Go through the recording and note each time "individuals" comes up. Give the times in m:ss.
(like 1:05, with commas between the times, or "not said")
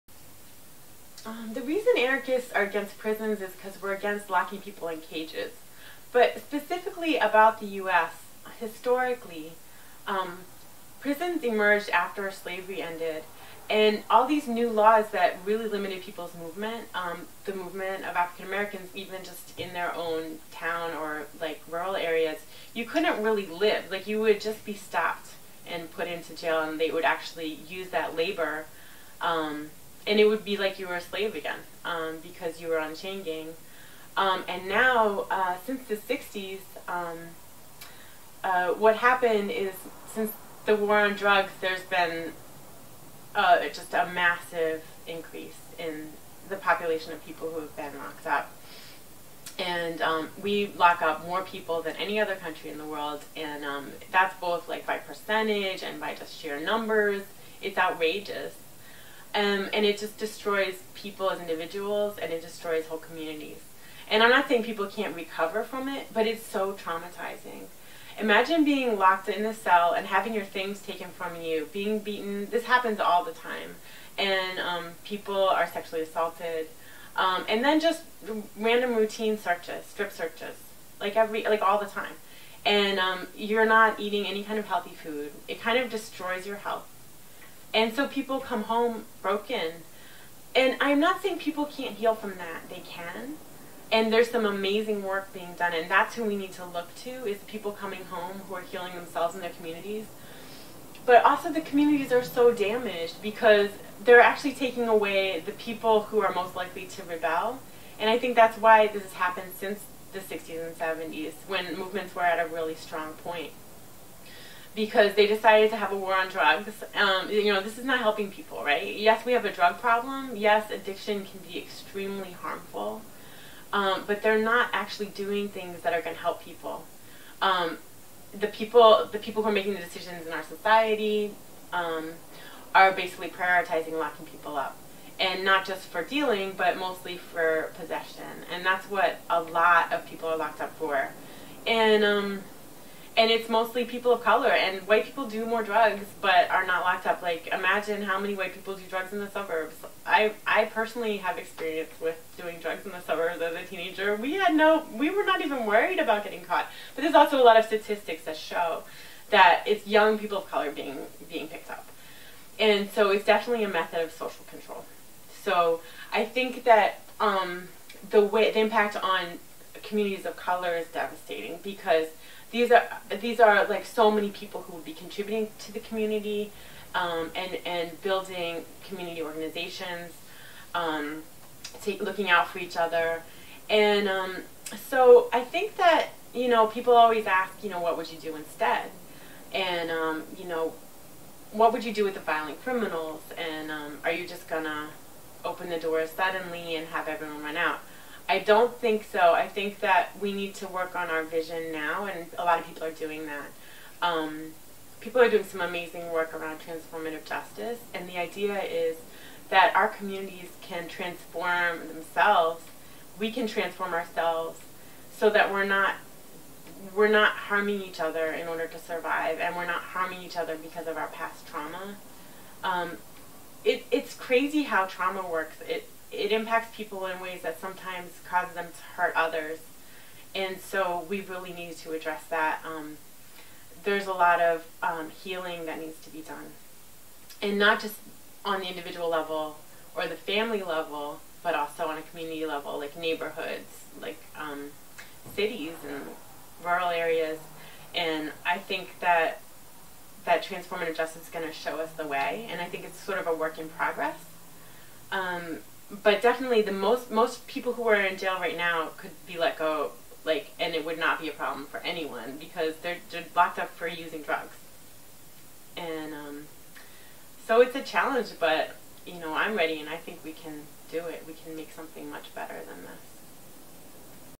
1:01, 3:58.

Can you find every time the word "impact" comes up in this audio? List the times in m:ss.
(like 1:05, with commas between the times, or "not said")
2:48, 3:46.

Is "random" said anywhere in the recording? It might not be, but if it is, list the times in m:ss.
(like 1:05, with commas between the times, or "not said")
1:18.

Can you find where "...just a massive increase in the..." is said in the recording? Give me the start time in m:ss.
0:43.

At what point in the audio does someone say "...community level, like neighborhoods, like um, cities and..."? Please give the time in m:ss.
4:02.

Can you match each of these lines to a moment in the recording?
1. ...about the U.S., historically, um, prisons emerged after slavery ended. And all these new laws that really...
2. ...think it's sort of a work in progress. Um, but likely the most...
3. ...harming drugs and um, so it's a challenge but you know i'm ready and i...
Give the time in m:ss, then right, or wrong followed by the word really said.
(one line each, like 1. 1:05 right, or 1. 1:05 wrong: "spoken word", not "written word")
1. 0:07 right
2. 4:12 wrong: "definitely", not "likely"
3. 4:23 wrong: "using", not "harming".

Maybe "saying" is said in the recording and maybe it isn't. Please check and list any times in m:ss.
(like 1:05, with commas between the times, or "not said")
1:04, 1:31.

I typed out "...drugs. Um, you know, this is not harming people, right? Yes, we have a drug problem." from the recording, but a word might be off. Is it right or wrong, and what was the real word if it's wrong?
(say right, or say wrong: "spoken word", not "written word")
wrong: "helping", not "harming".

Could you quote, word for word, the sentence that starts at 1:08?
Imagine being locked in a cell and having your things taken from you, being beaten.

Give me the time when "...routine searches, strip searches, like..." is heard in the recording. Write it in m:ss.
1:18.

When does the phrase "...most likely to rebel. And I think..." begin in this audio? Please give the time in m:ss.
1:46.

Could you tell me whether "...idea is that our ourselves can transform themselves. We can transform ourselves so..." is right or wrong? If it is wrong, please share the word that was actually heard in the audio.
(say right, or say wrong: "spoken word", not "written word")
wrong: "communities", not "ourselves".